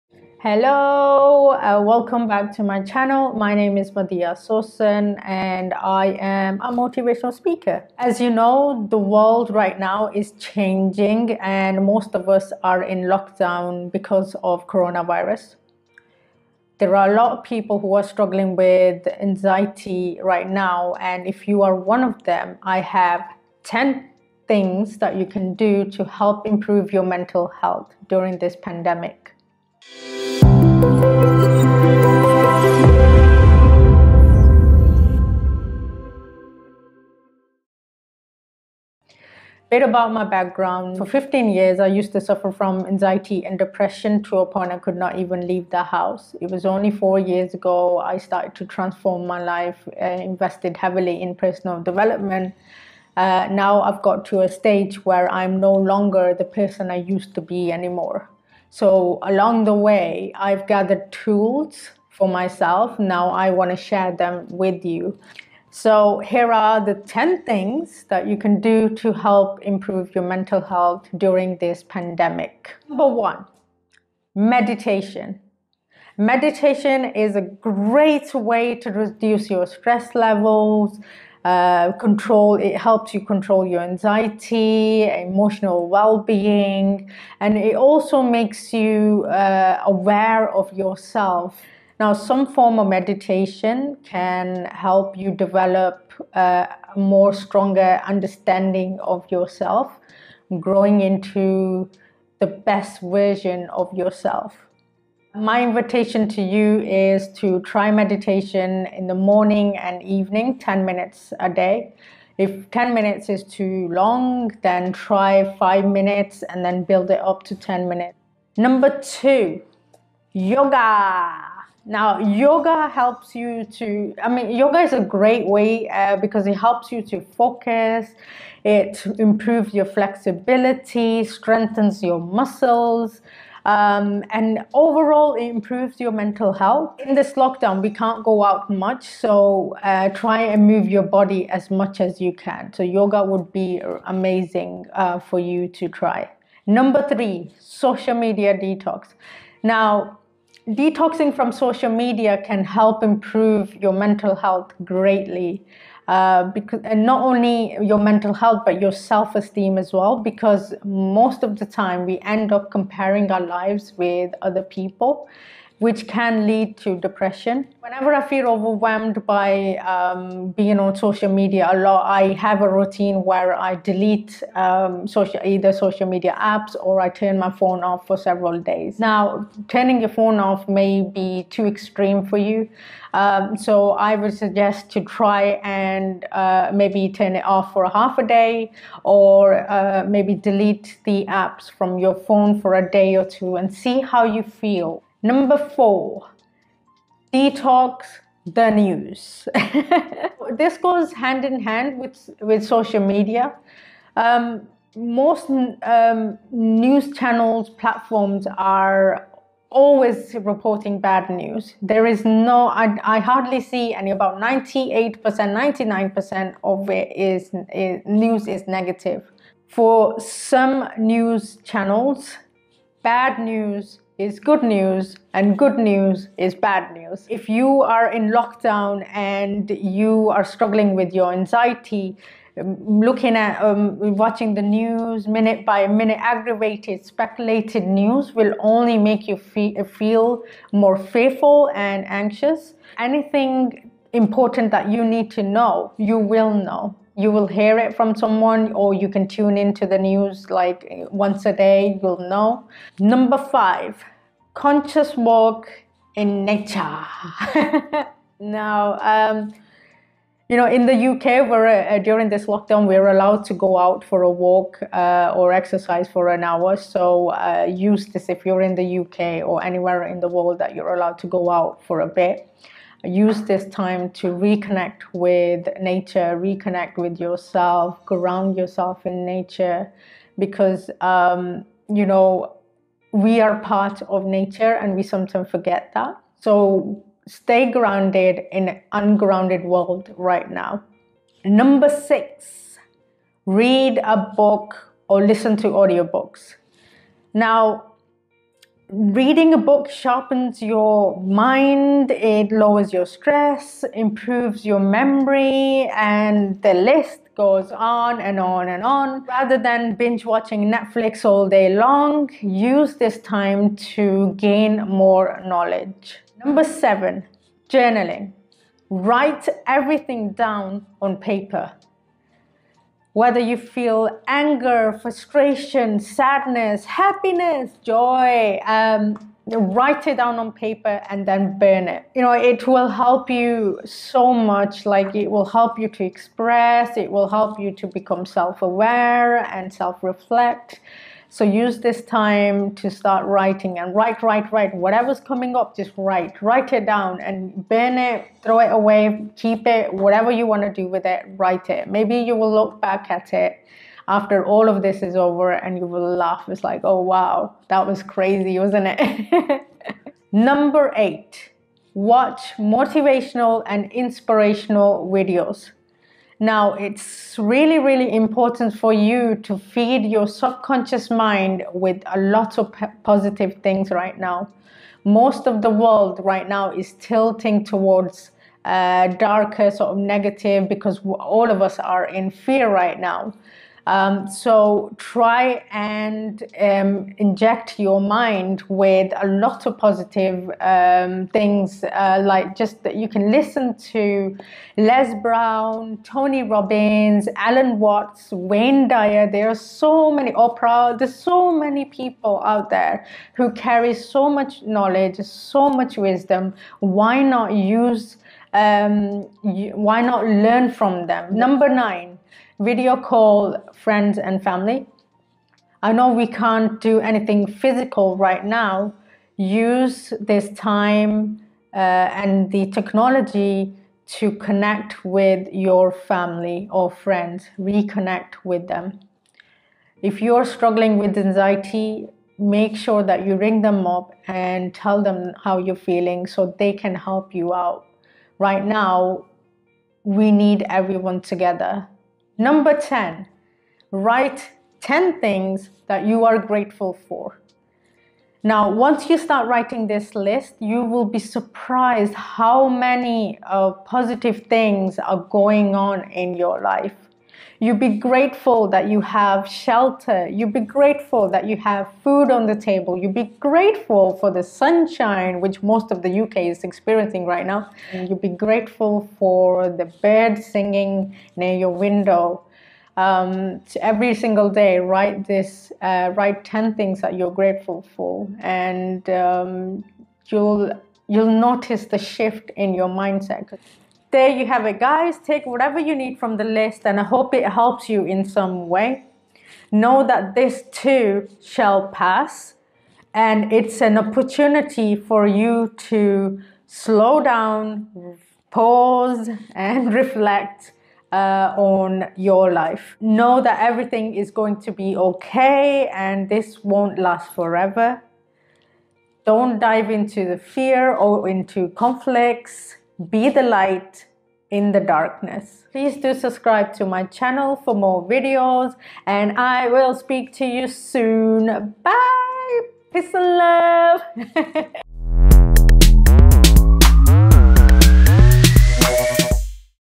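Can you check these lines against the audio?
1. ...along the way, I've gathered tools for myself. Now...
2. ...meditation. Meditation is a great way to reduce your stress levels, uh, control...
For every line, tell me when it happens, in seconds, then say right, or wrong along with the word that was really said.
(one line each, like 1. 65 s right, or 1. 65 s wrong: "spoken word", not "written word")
1. 59 s right
2. 74 s right.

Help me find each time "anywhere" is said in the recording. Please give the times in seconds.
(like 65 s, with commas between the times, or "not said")
269 s.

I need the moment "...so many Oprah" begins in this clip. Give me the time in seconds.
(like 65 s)
399 s.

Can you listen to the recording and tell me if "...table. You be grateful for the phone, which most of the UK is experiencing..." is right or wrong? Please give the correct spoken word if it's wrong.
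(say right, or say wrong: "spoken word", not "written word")
wrong: "sunshine", not "phone".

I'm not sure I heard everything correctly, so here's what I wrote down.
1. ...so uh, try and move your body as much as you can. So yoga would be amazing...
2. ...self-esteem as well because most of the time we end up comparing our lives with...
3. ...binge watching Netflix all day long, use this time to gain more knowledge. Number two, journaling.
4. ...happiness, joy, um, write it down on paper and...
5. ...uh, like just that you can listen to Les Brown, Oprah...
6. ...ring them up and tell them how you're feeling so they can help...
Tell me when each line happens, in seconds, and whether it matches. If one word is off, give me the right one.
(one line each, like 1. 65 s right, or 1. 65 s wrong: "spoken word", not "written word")
1. 139 s right
2. 158 s right
3. 309 s wrong: "seven", not "two"
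4. 326 s right
5. 391 s wrong: "Tony", not "Oprah"
6. 433 s right.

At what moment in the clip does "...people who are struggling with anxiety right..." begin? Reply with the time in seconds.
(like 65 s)
17 s.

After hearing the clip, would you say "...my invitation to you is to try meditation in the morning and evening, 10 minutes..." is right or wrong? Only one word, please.
right.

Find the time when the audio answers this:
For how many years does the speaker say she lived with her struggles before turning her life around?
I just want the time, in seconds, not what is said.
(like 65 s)
41 s.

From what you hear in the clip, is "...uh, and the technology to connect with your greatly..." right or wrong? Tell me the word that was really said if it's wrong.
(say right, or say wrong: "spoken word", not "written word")
wrong: "family", not "greatly".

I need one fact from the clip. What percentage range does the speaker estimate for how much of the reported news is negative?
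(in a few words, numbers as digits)
98-99%.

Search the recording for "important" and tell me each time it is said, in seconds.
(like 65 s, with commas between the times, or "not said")
244 s, 368 s.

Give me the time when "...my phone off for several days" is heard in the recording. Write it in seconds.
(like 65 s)
177 s.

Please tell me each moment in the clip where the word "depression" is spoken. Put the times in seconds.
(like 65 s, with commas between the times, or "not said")
43 s, 166 s.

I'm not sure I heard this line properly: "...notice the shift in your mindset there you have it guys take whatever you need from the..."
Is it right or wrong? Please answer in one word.
right.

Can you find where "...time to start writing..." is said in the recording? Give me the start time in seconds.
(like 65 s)
342 s.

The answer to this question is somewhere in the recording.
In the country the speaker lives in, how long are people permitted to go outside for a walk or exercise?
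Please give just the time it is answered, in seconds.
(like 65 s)
266 s.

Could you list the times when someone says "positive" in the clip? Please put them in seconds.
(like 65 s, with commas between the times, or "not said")
373 s, 389 s, 453 s.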